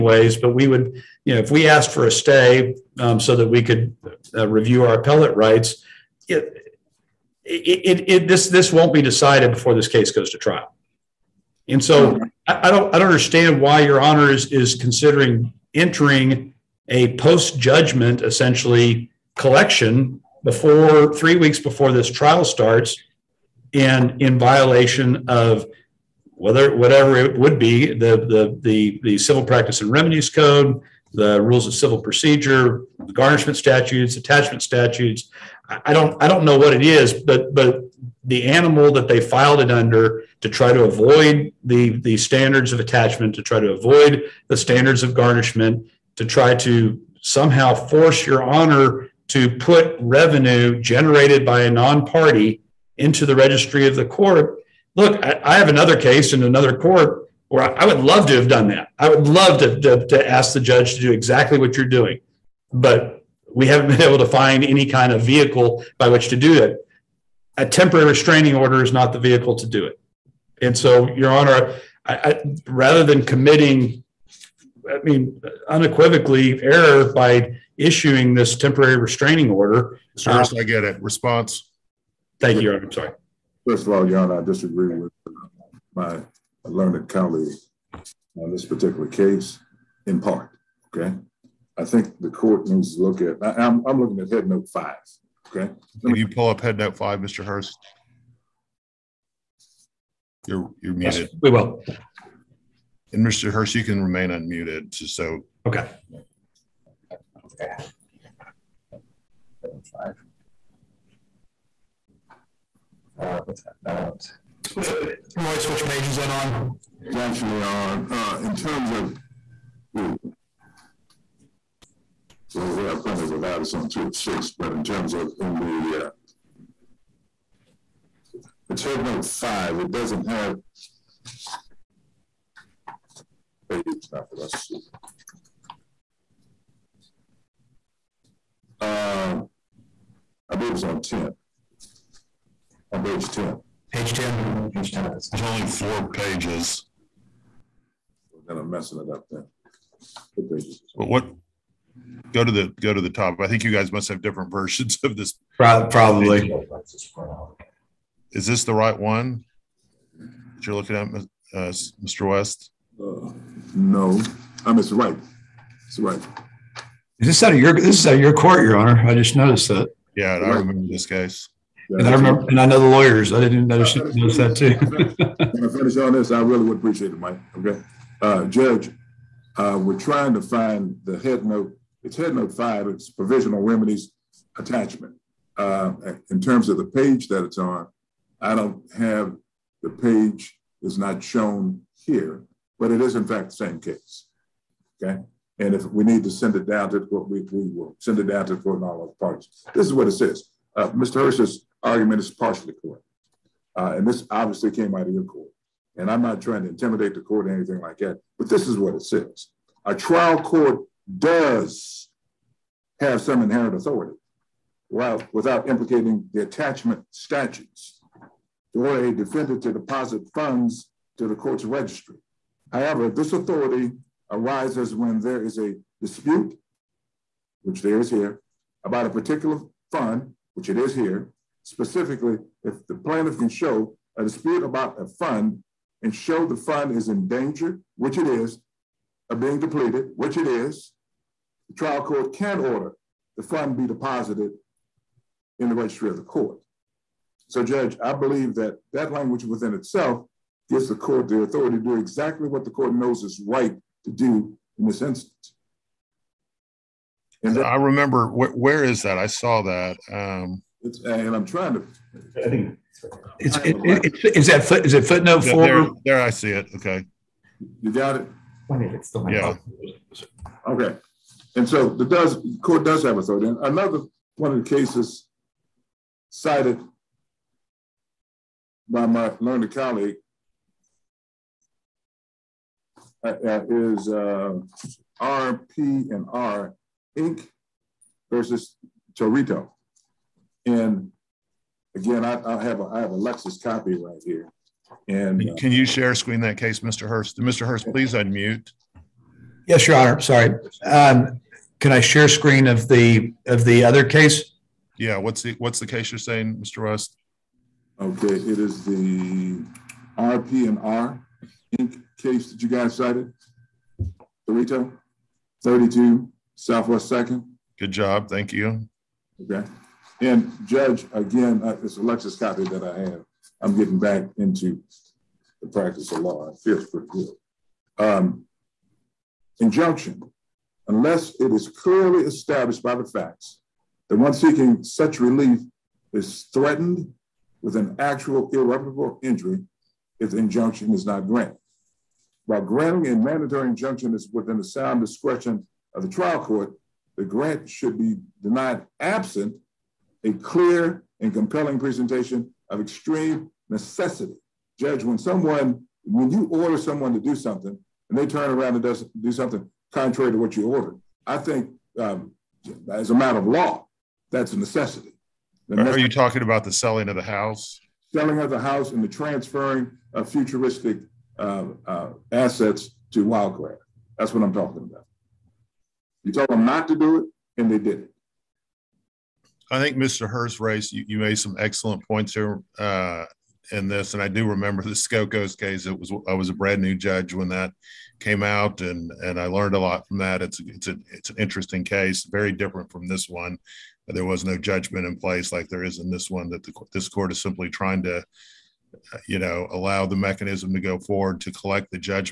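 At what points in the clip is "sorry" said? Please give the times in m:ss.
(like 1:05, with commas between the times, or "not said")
1:22, 5:00.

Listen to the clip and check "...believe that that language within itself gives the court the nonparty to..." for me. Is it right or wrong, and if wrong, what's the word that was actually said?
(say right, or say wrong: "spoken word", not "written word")
wrong: "authority", not "nonparty".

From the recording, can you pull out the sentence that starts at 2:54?
when I finish on this, I really would appreciate it, Mike.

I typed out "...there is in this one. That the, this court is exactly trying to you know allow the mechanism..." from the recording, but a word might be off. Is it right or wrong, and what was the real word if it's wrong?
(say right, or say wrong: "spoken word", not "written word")
wrong: "simply", not "exactly".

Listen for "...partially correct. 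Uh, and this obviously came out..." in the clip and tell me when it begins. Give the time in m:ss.
3:22.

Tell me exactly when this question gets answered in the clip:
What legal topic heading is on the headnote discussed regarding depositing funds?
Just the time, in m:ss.
3:03.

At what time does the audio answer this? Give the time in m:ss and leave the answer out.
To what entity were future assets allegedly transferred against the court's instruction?
6:13.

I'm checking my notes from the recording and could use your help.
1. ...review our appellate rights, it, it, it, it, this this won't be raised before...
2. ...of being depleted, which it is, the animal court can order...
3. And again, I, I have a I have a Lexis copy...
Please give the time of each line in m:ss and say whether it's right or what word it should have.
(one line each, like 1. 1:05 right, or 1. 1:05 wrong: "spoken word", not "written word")
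1. 0:04 wrong: "decided", not "raised"
2. 3:59 wrong: "trial", not "animal"
3. 4:50 right.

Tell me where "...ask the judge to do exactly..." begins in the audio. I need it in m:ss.
1:00.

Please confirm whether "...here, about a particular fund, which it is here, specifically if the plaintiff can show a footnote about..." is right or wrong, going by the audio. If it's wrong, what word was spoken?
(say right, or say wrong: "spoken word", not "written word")
wrong: "dispute", not "footnote".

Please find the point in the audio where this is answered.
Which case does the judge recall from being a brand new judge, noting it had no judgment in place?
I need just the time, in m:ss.
6:24.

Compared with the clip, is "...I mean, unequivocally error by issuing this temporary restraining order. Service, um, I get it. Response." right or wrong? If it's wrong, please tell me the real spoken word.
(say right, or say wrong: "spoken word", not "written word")
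right.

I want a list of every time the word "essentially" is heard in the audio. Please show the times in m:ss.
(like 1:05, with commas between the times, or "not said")
0:18.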